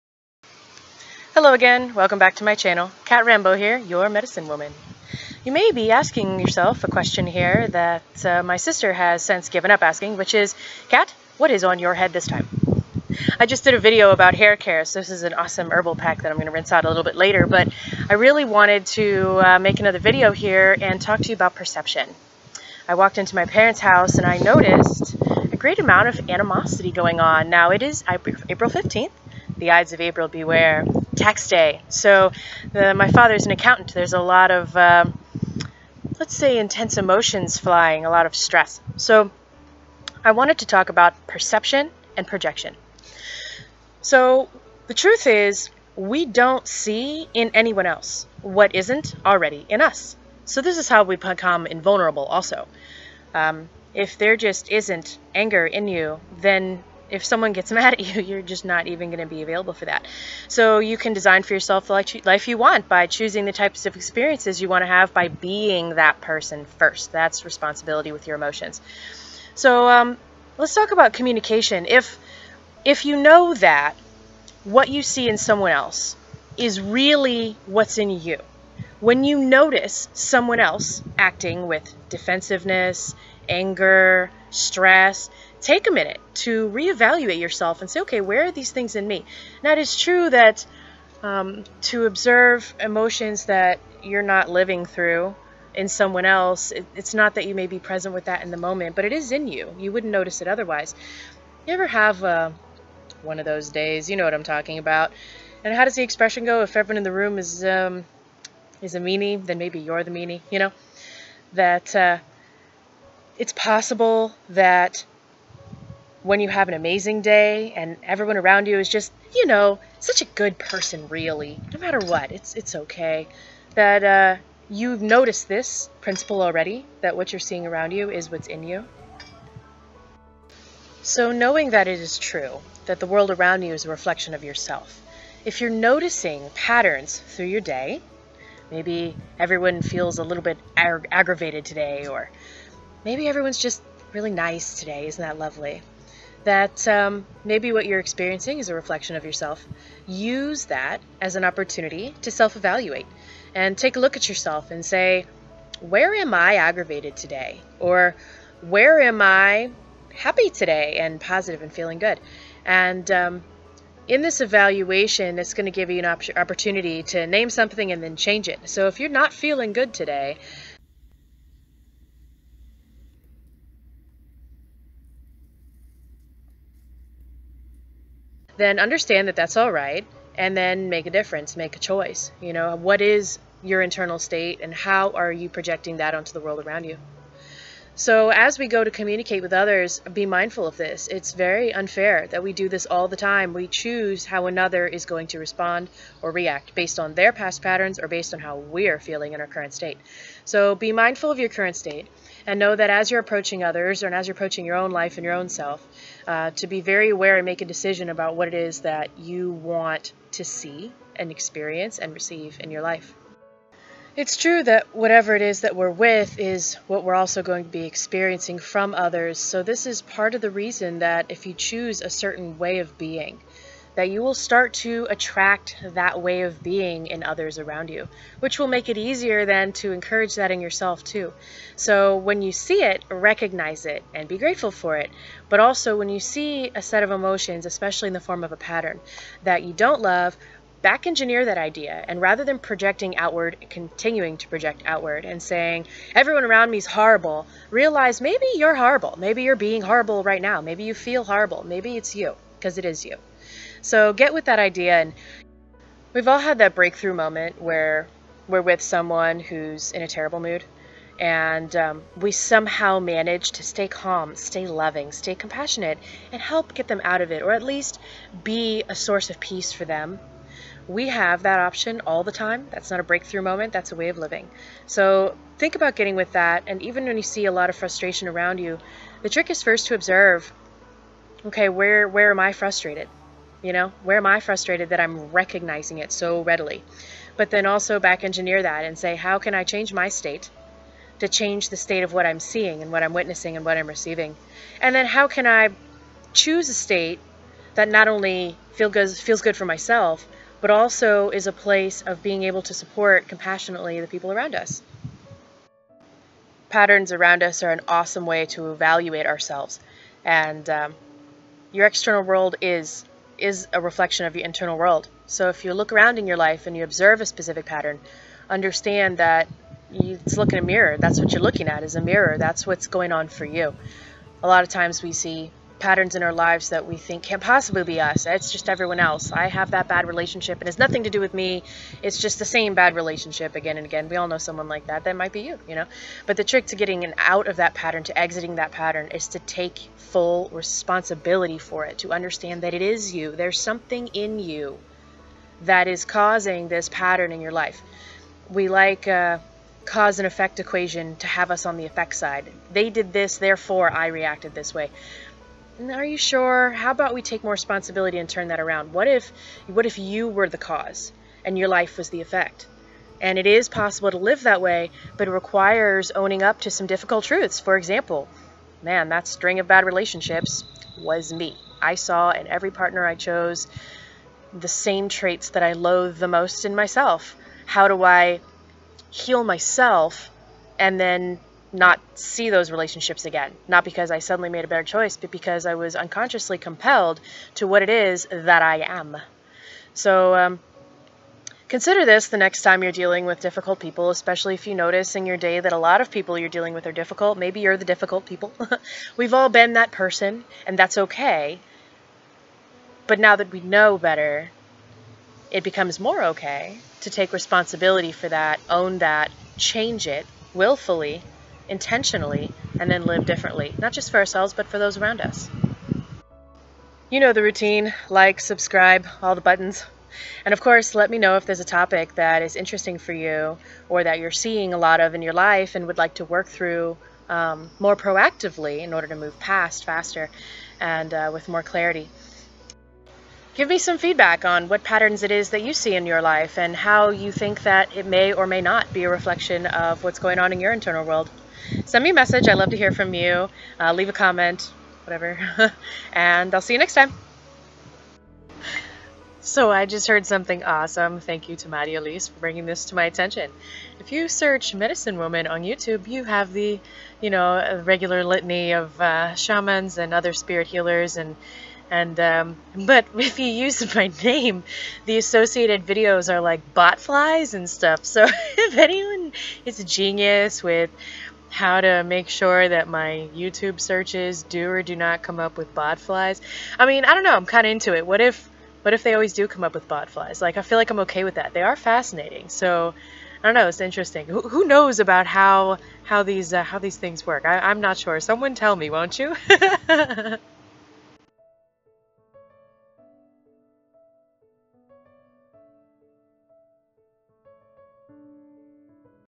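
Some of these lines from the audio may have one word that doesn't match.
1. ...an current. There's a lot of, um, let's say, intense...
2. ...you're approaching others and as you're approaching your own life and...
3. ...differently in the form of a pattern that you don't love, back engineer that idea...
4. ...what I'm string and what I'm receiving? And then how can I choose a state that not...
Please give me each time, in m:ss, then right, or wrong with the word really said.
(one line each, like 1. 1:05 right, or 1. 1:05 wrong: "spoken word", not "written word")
1. 0:33 wrong: "accountant", not "current"
2. 3:23 right
3. 3:57 wrong: "especially", not "differently"
4. 4:52 wrong: "witnessing", not "string".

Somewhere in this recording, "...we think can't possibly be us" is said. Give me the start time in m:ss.
5:26.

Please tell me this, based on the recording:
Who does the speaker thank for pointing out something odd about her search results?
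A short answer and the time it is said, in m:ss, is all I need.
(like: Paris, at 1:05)
Maddie Elise, at 7:31.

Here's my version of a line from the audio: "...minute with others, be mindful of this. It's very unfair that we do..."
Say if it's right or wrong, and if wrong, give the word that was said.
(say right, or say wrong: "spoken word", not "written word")
wrong: "communicate", not "minute".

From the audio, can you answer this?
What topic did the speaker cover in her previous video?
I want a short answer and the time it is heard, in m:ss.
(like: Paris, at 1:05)
Hair care, at 0:14.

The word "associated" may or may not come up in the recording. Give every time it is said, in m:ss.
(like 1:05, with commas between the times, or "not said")
7:45.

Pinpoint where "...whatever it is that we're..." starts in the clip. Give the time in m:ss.
3:34.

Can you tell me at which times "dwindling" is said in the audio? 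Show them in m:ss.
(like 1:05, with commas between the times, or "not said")
not said.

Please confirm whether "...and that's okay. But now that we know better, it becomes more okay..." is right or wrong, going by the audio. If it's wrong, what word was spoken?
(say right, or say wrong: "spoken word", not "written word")
right.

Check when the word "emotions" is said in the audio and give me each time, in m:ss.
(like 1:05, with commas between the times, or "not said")
0:36, 1:08, 1:32, 3:57.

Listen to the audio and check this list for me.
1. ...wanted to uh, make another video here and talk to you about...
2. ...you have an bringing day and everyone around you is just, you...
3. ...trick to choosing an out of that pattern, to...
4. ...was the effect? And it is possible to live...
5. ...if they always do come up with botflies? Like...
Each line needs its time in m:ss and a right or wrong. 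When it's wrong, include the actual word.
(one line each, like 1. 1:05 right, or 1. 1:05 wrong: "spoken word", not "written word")
1. 0:18 right
2. 1:56 wrong: "amazing", not "bringing"
3. 5:36 wrong: "getting", not "choosing"
4. 6:01 right
5. 7:58 right.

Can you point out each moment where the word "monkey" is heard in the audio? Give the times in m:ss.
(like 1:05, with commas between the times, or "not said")
not said.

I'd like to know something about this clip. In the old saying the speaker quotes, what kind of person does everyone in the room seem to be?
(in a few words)
A meanie.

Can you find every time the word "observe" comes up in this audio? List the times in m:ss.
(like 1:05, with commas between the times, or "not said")
1:32, 4:39, 5:16.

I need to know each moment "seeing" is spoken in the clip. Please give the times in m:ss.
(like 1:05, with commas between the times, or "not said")
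2:07, 4:52, 7:04.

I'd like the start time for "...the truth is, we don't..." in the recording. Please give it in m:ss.
0:44.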